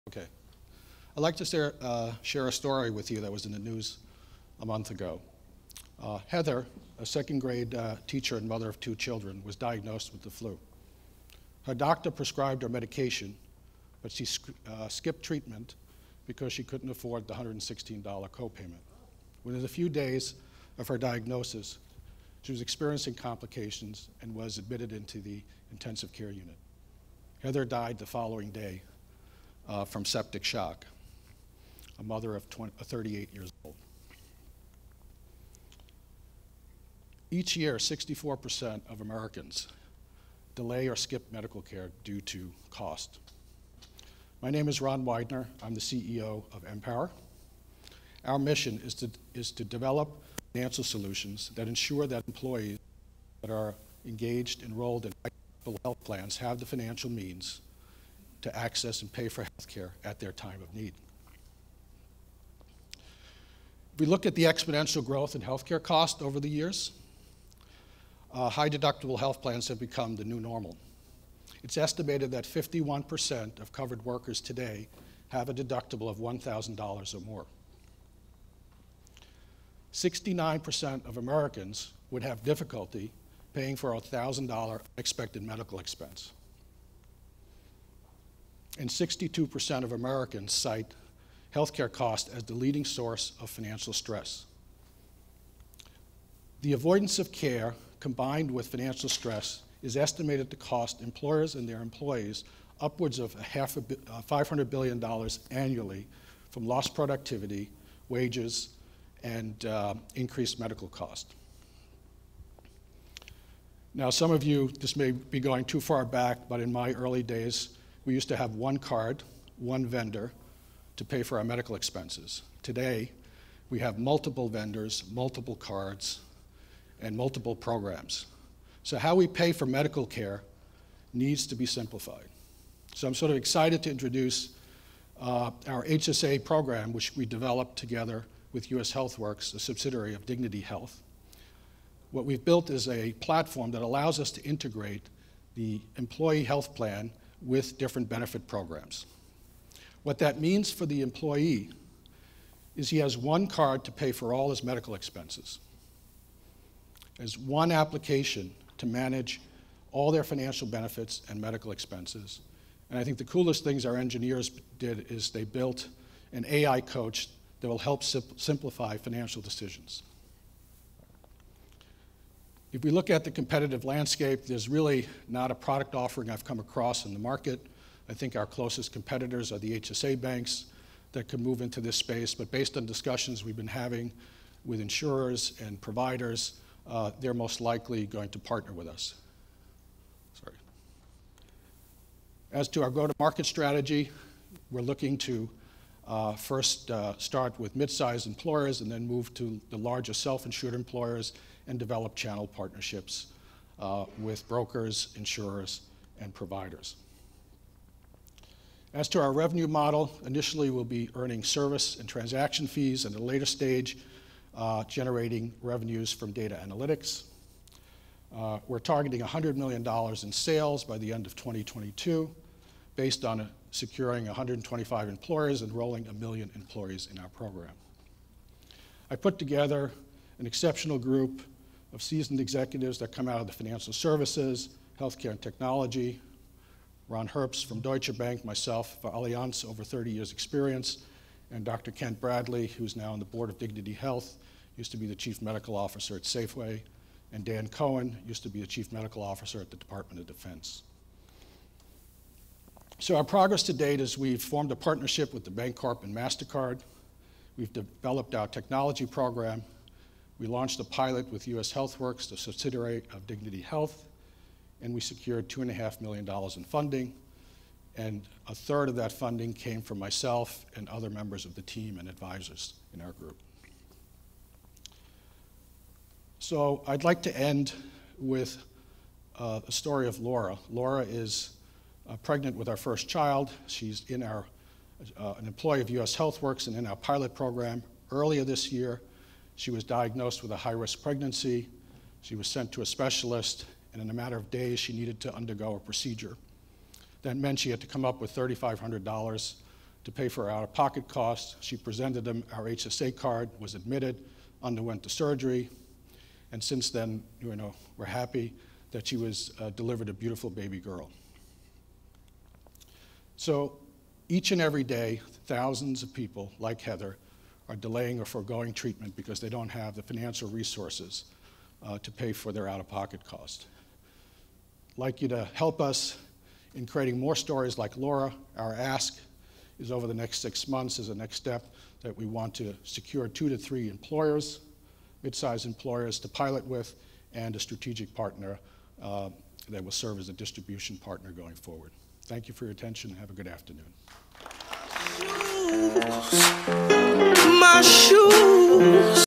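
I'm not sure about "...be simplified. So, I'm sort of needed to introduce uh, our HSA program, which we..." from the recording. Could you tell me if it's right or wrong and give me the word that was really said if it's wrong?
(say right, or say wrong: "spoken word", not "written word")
wrong: "excited", not "needed".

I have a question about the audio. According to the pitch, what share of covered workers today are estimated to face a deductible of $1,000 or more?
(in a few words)
51%.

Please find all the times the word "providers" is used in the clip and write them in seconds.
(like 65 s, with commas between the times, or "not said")
185 s, 206 s.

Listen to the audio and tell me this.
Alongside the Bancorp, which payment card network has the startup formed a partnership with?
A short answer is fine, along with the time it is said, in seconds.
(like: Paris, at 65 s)
MasterCard, at 256 s.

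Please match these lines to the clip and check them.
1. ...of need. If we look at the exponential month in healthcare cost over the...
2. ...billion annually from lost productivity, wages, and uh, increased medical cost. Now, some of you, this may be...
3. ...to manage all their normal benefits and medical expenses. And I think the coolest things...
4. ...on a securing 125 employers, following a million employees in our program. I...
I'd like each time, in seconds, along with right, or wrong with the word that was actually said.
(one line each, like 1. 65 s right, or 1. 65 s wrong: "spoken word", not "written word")
1. 60 s wrong: "growth", not "month"
2. 104 s right
3. 158 s wrong: "financial", not "normal"
4. 223 s wrong: "enrolling", not "following".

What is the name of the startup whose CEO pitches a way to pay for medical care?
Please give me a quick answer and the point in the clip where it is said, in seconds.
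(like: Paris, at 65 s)
Empower, at 46 s.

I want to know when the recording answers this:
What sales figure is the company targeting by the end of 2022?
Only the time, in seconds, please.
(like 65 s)
219 s.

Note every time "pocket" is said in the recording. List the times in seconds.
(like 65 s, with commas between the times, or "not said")
300 s, 322 s.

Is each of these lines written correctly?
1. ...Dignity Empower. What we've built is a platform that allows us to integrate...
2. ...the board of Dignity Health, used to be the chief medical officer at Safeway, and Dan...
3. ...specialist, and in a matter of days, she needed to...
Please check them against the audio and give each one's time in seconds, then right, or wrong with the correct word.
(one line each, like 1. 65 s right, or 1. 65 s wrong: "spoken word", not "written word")
1. 140 s wrong: "Health", not "Empower"
2. 243 s right
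3. 292 s right.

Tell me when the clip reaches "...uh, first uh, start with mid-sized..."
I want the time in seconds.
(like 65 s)
196 s.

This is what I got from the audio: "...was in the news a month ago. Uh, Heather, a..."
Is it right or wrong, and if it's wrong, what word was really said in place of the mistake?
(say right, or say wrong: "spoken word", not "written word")
right.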